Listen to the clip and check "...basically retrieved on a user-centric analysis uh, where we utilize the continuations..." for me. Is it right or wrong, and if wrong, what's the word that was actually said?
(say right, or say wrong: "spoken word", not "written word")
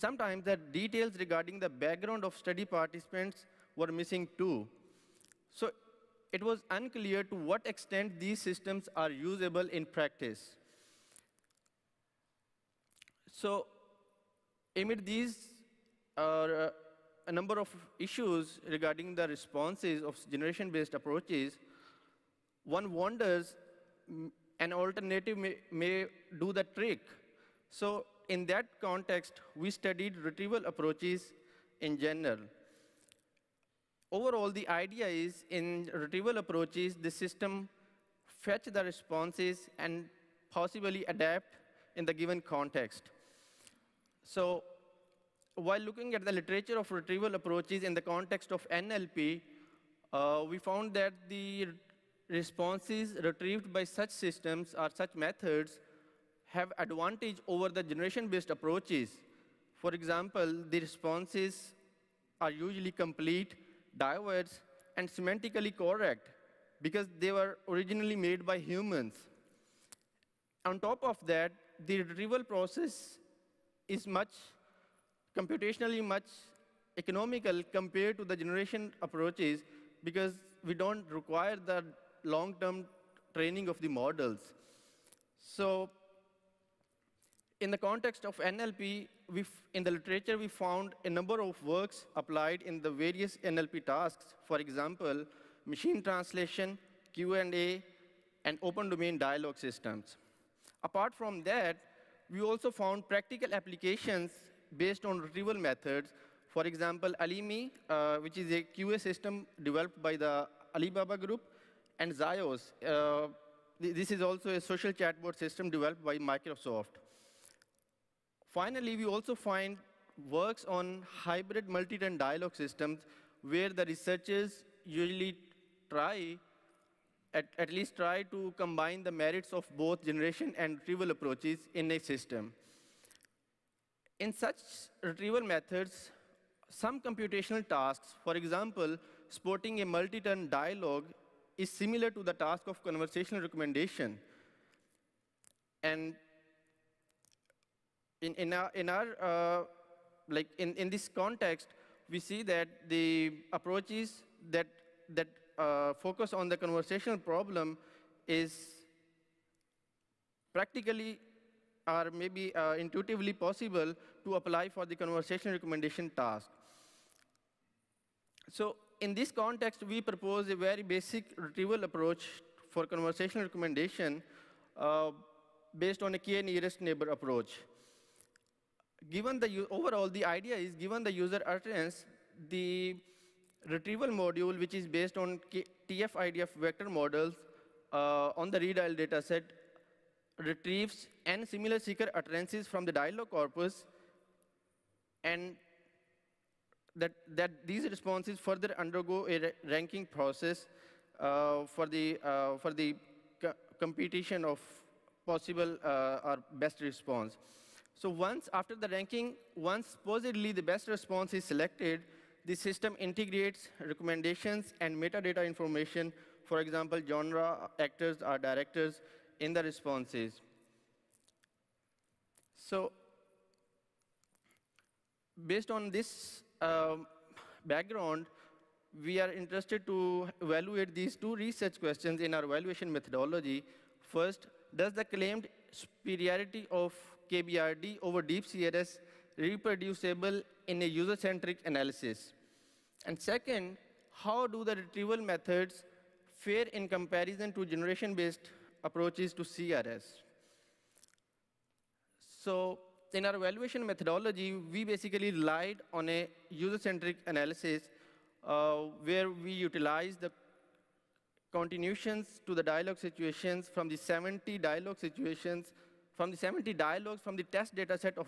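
wrong: "relied", not "retrieved".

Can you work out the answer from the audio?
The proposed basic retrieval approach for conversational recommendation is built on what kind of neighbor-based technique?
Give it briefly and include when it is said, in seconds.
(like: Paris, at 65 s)
k nearest neighbor, at 176 s.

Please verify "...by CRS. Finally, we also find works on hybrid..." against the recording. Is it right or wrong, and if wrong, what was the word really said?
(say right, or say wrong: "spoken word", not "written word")
wrong: "Microsoft", not "CRS".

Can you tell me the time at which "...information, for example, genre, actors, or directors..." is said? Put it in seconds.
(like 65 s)
215 s.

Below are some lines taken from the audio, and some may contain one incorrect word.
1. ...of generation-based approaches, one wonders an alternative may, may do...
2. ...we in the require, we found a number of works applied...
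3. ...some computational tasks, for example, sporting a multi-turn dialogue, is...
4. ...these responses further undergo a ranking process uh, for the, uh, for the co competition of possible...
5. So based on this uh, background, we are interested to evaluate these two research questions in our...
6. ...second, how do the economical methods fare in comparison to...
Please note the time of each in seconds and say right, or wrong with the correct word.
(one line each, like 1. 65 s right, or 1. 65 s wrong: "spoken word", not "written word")
1. 20 s right
2. 89 s wrong: "literature", not "require"
3. 136 s right
4. 197 s right
5. 222 s right
6. 243 s wrong: "retrieval", not "economical".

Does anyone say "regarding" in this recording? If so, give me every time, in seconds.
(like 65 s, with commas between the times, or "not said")
1 s, 18 s.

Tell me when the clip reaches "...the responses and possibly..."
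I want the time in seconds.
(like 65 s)
38 s.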